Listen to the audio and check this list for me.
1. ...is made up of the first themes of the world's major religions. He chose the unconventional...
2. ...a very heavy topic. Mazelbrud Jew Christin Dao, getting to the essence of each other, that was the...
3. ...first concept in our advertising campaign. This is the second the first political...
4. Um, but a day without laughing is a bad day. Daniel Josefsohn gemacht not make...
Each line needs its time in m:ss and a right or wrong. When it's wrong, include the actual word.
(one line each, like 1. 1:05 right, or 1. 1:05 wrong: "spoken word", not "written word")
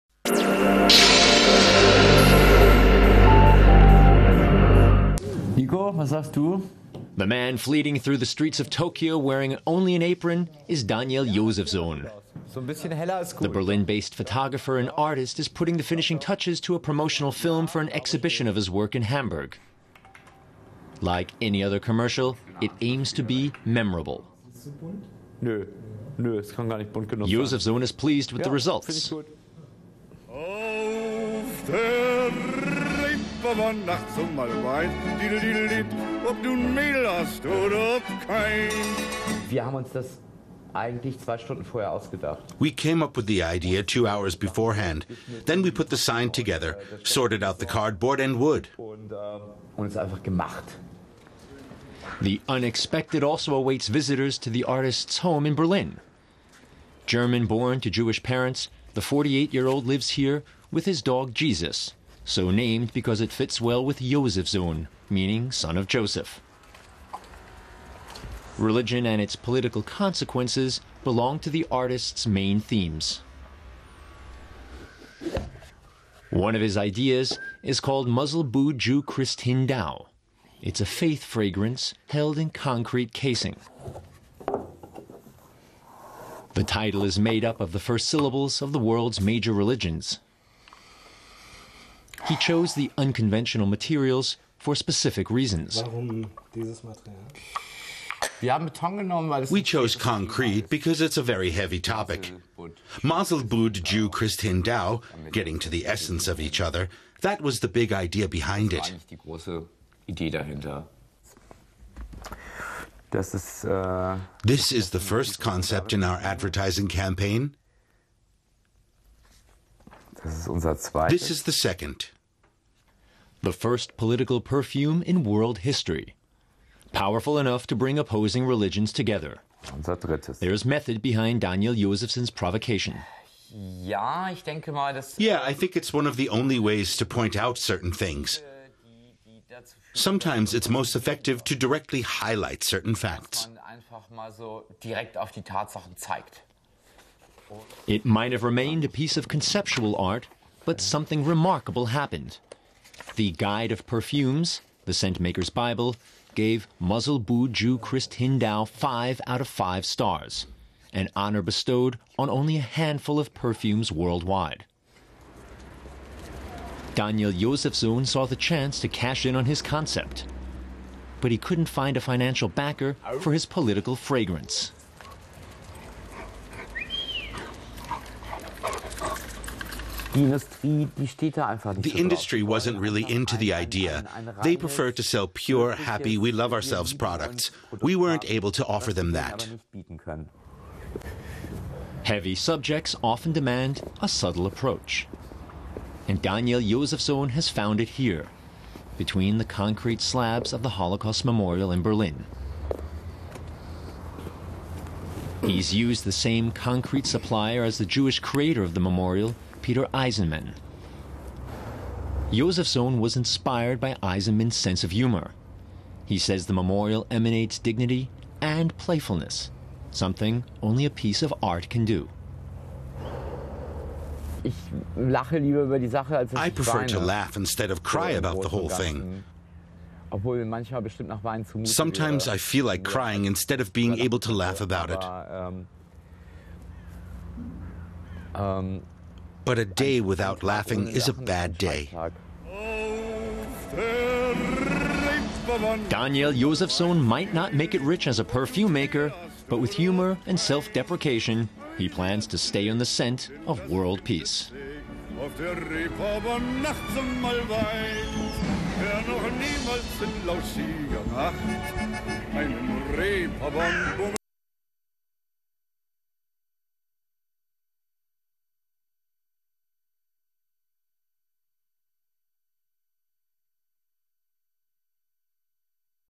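1. 1:27 wrong: "syllables", not "themes"
2. 1:41 right
3. 1:55 right
4. 3:58 wrong: "might", not "gemacht".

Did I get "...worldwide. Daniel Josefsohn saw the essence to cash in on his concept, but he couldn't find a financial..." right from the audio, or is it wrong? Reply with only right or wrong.
wrong.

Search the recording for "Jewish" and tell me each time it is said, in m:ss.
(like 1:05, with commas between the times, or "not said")
0:57, 3:27.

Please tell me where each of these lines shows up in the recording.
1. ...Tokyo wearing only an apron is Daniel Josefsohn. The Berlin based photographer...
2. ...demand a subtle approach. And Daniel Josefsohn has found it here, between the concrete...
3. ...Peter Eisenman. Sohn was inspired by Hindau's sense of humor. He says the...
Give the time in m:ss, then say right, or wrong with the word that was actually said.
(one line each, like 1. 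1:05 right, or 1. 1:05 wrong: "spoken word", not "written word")
1. 0:08 right
2. 3:13 right
3. 3:29 wrong: "Eisenman", not "Hindau".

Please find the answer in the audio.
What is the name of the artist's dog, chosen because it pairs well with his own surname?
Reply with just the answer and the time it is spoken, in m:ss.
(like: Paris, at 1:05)
Jesus, at 1:01.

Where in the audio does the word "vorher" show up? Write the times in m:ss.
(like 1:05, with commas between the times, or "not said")
0:41.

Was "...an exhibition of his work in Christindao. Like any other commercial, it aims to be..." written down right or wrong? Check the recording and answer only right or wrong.
wrong.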